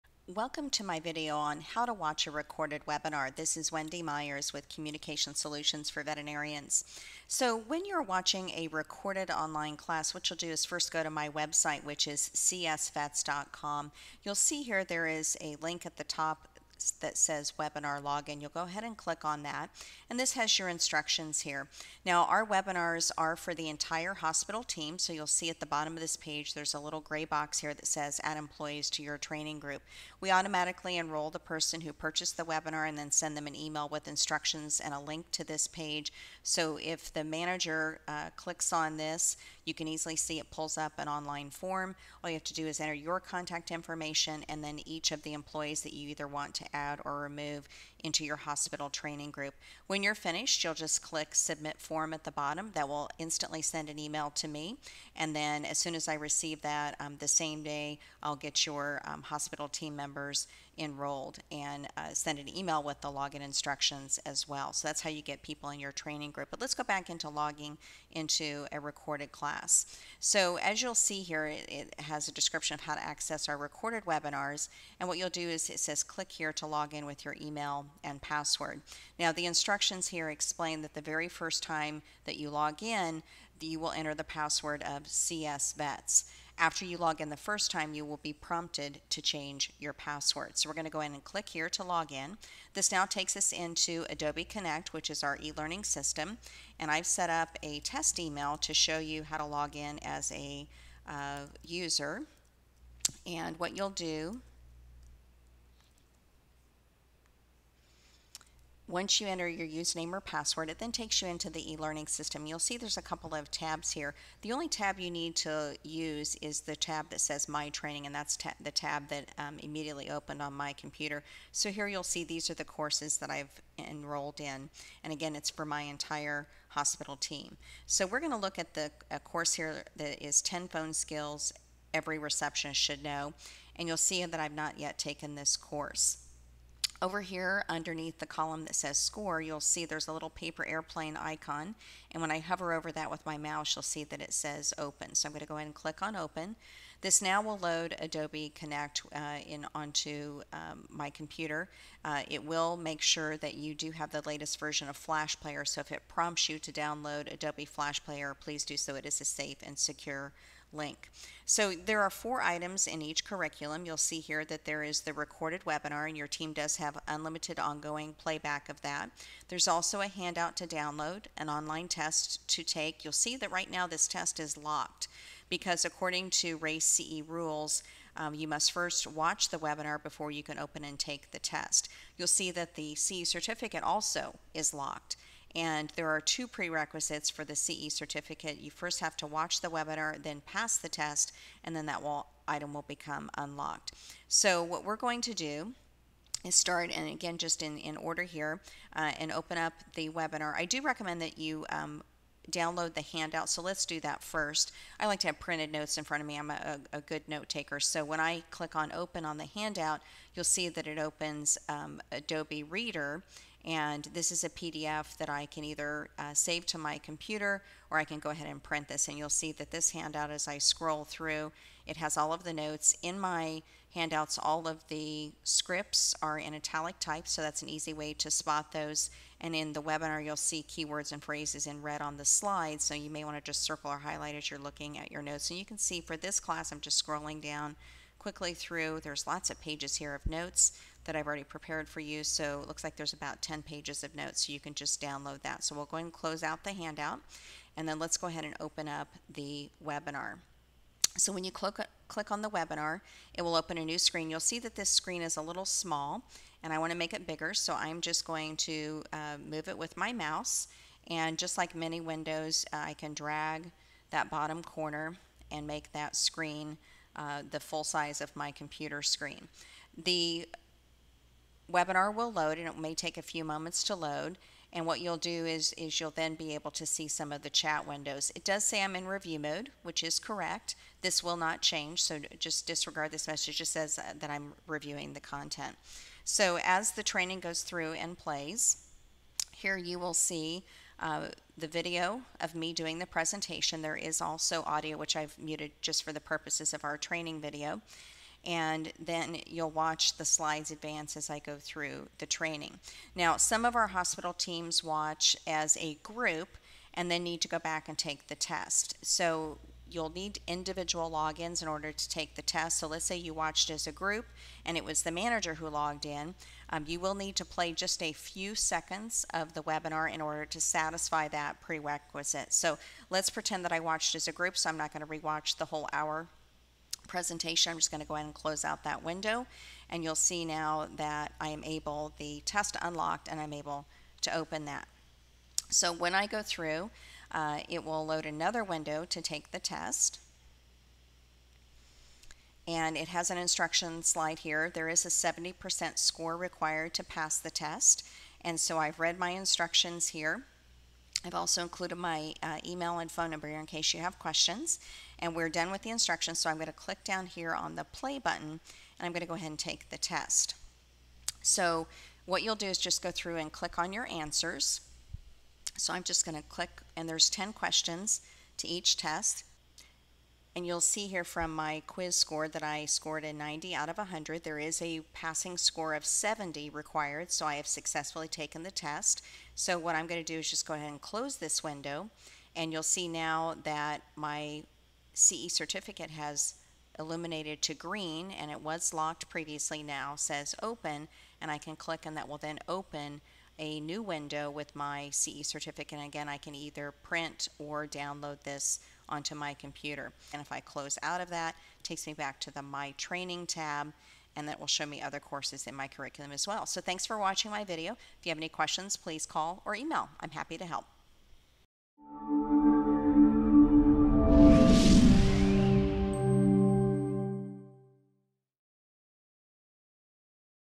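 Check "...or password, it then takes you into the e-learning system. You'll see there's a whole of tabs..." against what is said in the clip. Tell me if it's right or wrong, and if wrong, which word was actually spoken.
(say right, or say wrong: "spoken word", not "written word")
wrong: "couple", not "whole".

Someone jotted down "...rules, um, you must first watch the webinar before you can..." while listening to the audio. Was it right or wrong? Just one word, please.
right.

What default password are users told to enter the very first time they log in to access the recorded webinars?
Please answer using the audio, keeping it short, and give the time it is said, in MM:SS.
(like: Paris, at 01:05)
CSVets, at 01:25.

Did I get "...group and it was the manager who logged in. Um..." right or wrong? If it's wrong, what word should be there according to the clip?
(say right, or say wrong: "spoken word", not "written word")
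right.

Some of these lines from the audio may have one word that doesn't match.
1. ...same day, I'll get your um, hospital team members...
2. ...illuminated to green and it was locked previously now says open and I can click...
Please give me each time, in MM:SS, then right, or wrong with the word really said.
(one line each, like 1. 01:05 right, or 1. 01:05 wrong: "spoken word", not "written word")
1. 00:57 right
2. 06:26 right.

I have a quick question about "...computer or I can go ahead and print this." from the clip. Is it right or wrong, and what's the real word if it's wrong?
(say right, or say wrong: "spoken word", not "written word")
right.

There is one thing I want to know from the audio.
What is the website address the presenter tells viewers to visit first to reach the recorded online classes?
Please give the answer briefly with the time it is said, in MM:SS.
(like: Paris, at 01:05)
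csvets.com, at 00:12.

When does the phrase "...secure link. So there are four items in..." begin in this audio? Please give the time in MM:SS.
02:39.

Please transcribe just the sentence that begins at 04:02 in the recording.
So it looks like there's about 10 pages of notes, so you can just download that.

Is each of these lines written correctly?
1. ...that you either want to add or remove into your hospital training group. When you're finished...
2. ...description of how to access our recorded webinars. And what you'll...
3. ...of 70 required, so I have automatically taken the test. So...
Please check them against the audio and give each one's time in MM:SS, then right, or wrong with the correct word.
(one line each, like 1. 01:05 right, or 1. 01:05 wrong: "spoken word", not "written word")
1. 00:45 right
2. 01:12 right
3. 06:15 wrong: "successfully", not "automatically".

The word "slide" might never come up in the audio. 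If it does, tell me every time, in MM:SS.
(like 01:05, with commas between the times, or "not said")
03:52, 05:00, 05:44.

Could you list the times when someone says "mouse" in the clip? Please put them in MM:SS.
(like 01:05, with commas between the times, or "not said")
02:23, 04:20.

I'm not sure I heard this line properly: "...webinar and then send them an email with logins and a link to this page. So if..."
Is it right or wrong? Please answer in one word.
wrong.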